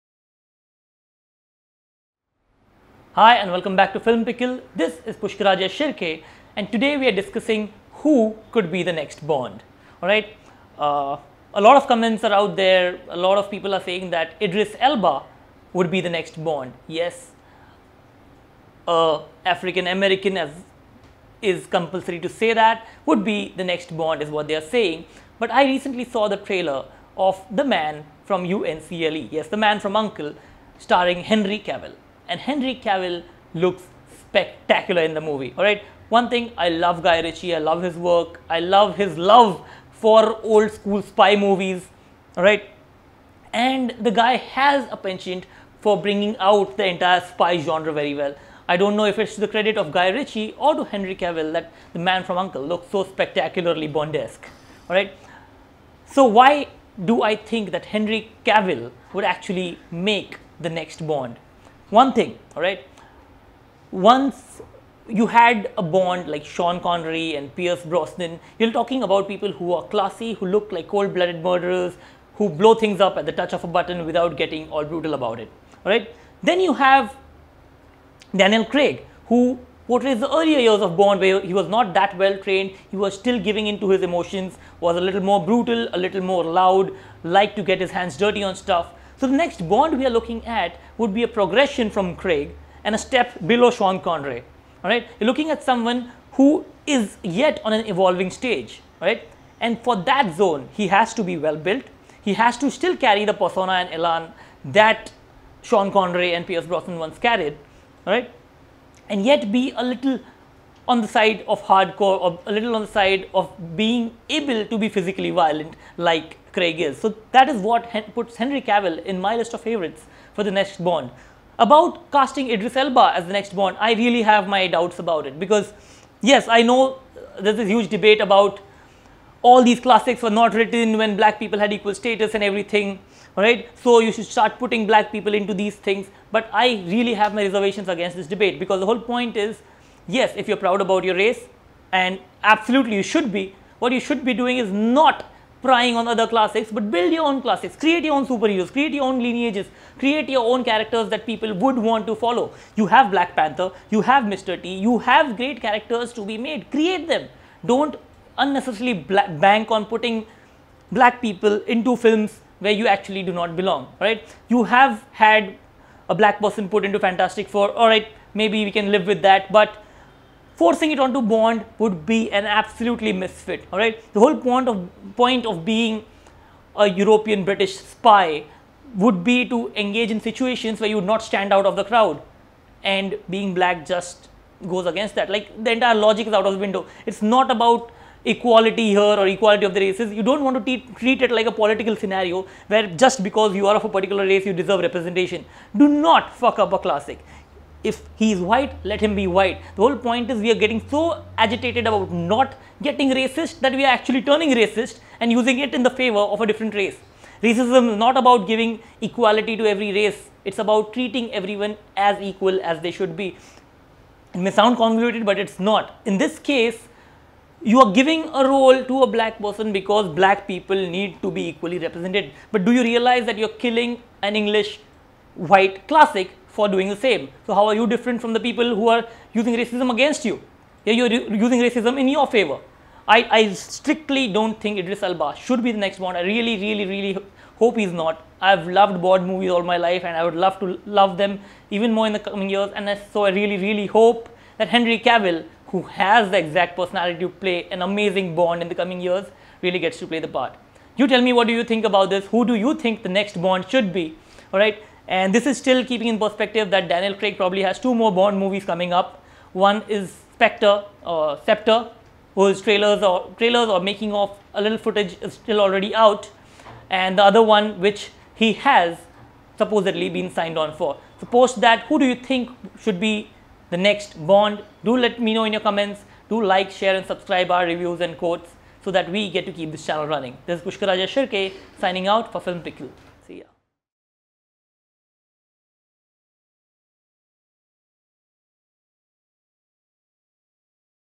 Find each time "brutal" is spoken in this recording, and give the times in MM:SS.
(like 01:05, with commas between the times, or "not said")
01:14, 01:25.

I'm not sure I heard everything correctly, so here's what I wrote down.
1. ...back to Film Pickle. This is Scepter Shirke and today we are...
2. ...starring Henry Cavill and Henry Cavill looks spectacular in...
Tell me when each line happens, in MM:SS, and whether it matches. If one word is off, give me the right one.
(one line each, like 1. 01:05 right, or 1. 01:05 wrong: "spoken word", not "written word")
1. 00:03 wrong: "Pushkaraja", not "Scepter"
2. 00:30 right.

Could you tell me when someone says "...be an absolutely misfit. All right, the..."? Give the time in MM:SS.
02:52.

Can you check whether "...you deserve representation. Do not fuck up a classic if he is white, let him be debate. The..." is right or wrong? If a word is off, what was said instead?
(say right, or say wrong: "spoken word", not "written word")
wrong: "white", not "debate".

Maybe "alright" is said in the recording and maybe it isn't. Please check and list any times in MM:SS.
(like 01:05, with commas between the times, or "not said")
00:10, 02:47.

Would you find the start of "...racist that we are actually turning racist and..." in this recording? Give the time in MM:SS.
03:23.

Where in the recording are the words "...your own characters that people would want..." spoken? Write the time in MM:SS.
02:30.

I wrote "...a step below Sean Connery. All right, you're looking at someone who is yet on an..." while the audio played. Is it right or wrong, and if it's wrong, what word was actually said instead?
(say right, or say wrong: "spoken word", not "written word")
right.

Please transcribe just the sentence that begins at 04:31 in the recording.
So post that, who do you think should be the next Bond?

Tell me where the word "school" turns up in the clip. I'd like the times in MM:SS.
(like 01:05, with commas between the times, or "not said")
00:40.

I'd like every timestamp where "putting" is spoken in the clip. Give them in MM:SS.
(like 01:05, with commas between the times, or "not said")
02:14, 02:39.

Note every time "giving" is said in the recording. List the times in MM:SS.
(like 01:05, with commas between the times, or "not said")
01:23, 03:28, 03:37.